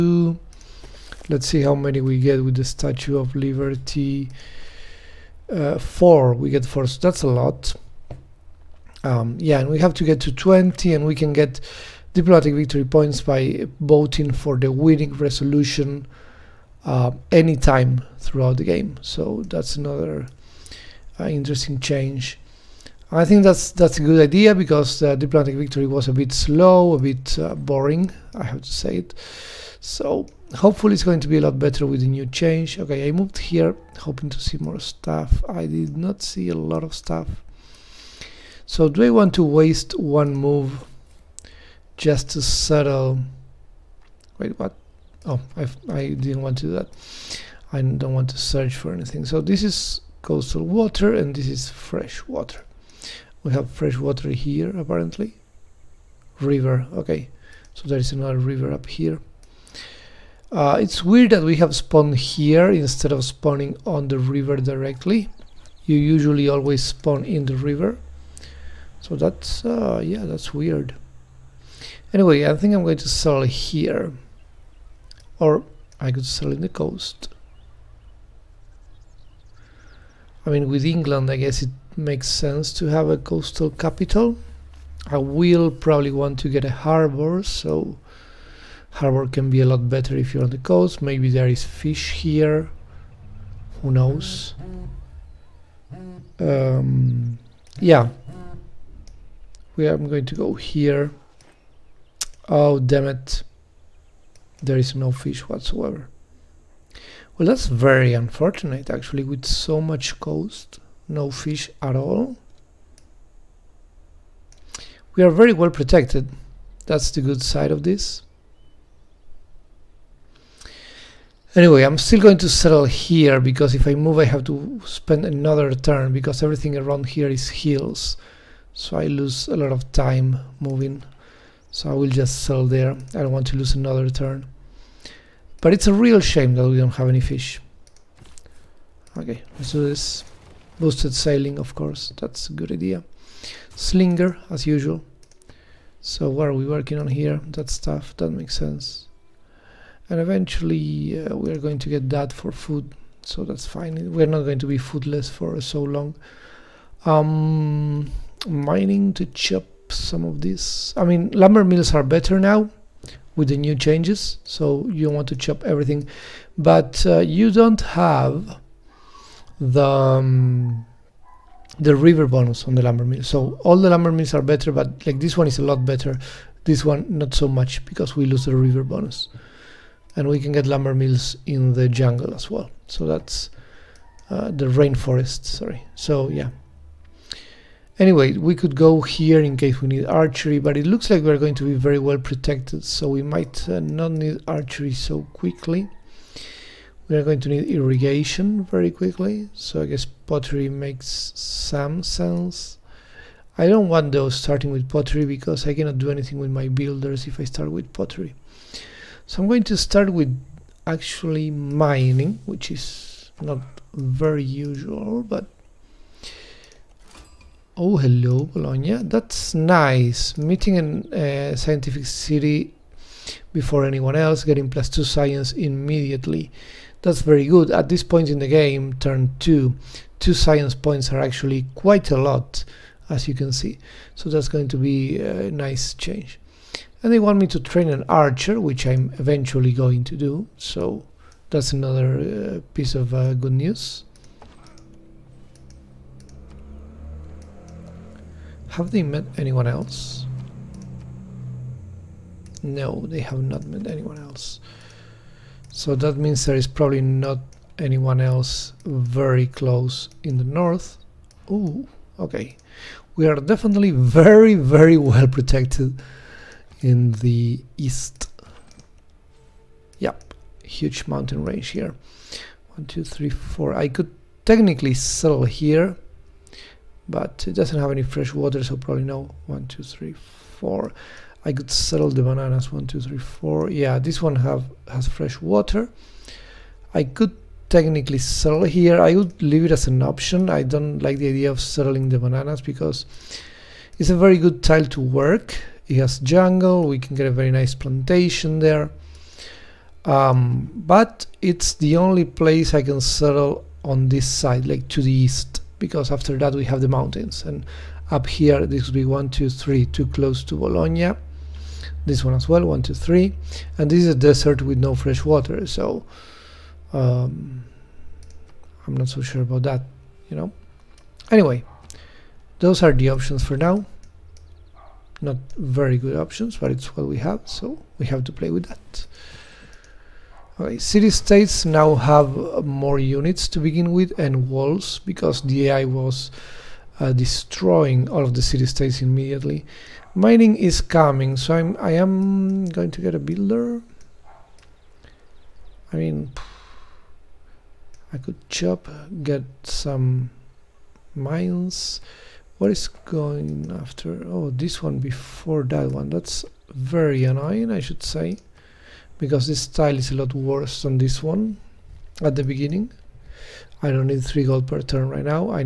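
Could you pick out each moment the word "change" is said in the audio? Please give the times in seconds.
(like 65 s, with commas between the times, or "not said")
21 s, 32 s, 163 s, 235 s.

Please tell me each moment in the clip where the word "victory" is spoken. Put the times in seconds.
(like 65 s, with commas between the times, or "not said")
12 s, 25 s.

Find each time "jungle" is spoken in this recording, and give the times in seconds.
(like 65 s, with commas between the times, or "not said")
181 s, 296 s.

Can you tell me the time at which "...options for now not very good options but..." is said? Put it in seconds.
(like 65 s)
323 s.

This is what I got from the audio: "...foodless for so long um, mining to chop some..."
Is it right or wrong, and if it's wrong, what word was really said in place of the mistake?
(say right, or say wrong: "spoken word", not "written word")
right.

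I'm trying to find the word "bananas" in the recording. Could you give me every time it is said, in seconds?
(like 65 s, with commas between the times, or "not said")
282 s, 292 s.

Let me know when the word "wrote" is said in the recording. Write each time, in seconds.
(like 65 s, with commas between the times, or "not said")
not said.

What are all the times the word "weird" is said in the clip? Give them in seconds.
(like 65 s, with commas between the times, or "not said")
61 s, 70 s.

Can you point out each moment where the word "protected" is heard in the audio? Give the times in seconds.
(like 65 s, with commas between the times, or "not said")
115 s, 192 s, 265 s.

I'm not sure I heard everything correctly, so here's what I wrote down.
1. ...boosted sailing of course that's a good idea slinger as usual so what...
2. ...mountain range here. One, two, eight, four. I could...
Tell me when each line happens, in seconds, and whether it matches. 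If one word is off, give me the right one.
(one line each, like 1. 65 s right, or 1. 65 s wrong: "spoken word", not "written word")
1. 140 s right
2. 271 s wrong: "three", not "eight".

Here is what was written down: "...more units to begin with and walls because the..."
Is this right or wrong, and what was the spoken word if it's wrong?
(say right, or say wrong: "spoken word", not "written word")
right.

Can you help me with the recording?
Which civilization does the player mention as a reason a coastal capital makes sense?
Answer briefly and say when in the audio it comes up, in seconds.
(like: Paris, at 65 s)
England, at 80 s.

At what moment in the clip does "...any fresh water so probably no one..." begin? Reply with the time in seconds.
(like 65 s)
277 s.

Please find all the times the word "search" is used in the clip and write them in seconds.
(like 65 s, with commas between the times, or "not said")
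48 s.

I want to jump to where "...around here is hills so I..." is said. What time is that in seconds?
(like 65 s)
126 s.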